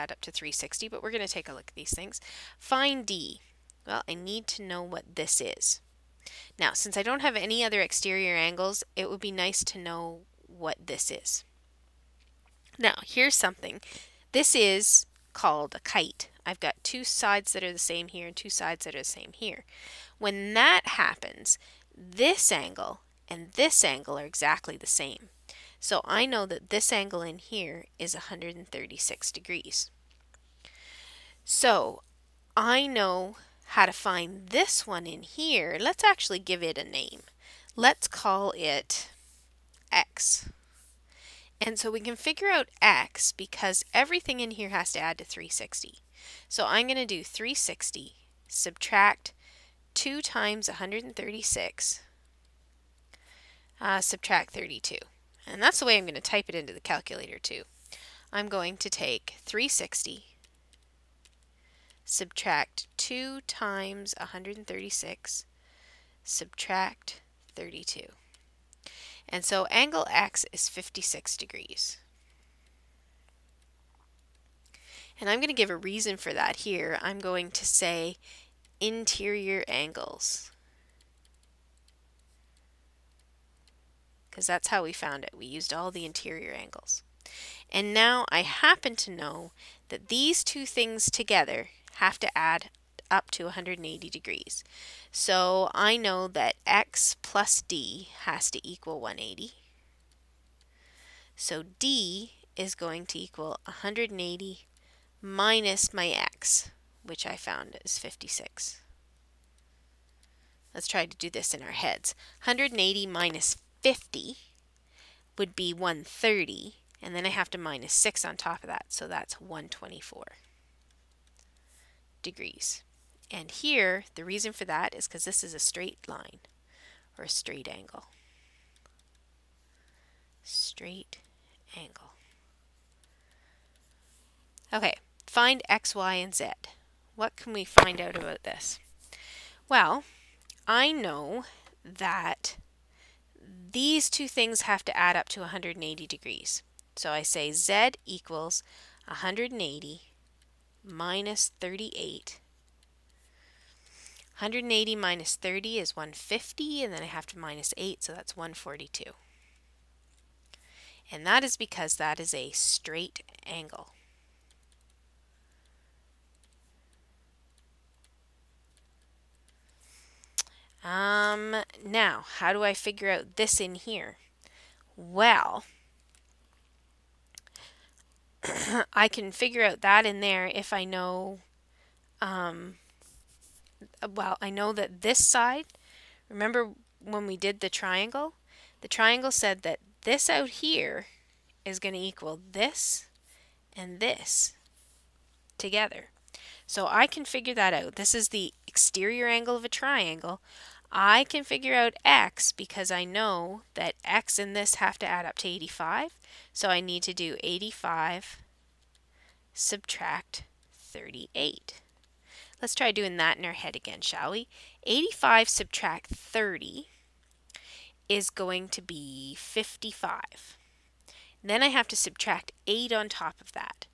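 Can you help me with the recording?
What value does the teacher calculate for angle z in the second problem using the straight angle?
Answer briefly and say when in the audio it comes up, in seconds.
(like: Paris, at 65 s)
142, at 158 s.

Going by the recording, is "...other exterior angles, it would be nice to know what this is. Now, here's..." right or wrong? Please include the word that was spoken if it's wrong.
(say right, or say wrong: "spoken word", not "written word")
right.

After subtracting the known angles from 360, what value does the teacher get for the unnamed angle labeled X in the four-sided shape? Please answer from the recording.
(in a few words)
56 degrees.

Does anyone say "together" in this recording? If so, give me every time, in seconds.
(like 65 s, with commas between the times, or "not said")
91 s, 195 s.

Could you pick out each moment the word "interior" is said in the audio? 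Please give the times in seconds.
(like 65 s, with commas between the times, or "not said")
78 s, 86 s.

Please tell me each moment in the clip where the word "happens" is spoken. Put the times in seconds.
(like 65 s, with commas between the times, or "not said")
20 s, 88 s.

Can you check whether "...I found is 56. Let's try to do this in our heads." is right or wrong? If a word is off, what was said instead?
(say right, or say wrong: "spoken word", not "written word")
right.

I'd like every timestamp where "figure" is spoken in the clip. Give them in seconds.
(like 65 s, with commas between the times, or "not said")
42 s, 172 s, 179 s, 197 s, 201 s.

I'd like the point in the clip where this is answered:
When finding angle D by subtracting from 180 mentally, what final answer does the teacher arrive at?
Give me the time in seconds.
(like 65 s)
119 s.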